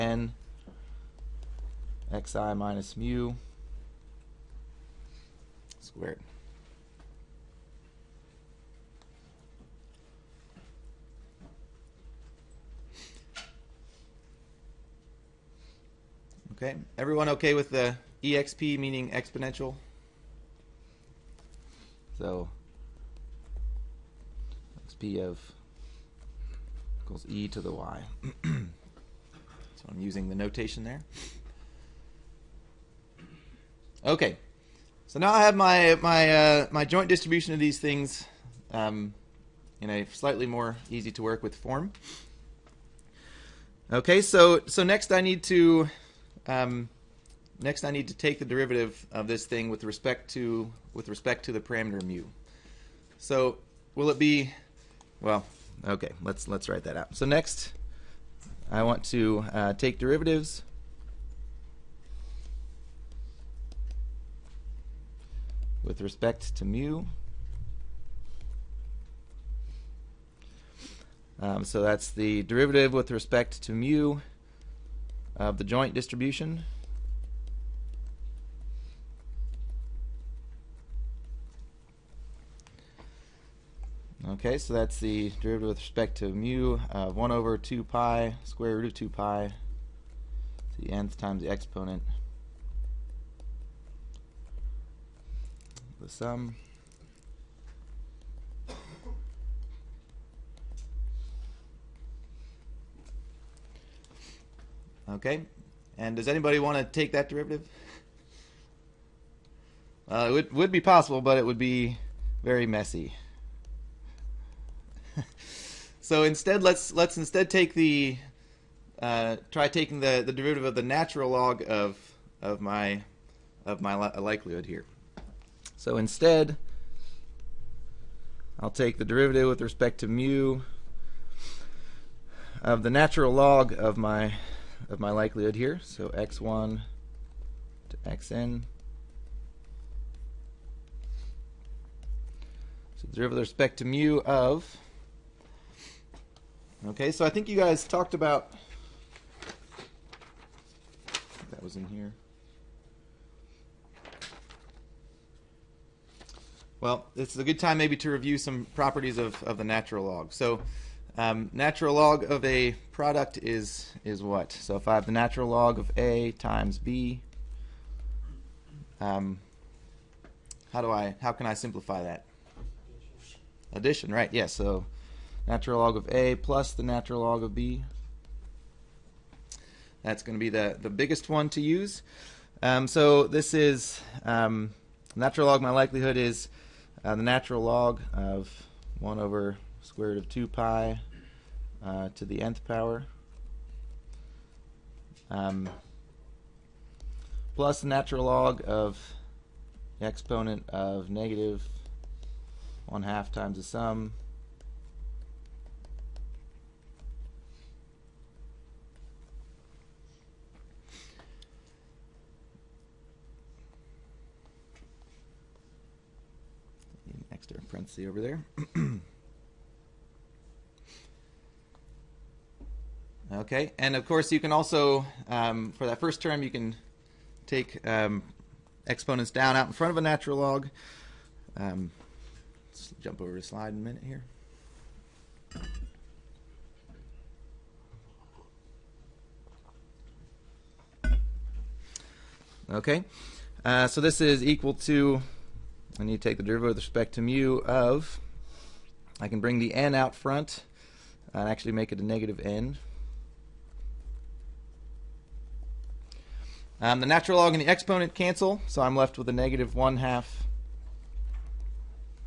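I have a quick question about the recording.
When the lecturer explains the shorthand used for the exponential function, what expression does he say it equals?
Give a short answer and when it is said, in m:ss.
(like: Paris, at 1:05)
e to the y, at 0:27.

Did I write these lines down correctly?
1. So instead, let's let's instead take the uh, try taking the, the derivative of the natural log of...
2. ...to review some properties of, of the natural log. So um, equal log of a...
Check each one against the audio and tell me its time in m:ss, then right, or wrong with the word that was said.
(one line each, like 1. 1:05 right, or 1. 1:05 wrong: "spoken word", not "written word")
1. 1:56 right
2. 2:37 wrong: "natural", not "equal".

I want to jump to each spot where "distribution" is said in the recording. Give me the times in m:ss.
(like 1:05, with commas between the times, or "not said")
0:37, 1:15.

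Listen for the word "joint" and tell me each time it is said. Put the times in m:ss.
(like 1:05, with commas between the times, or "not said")
0:36, 1:15.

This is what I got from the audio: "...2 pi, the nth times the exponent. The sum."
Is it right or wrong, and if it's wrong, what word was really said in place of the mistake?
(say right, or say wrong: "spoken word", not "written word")
right.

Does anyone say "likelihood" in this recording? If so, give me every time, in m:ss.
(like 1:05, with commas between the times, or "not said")
2:04, 2:15, 3:05.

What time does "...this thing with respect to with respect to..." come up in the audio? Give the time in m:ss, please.
0:49.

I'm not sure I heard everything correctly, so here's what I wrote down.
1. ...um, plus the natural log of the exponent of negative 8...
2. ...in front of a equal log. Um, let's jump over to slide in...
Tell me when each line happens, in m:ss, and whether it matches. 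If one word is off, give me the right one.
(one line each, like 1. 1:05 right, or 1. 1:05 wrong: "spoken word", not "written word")
1. 3:15 wrong: "1", not "8"
2. 3:49 wrong: "natural", not "equal".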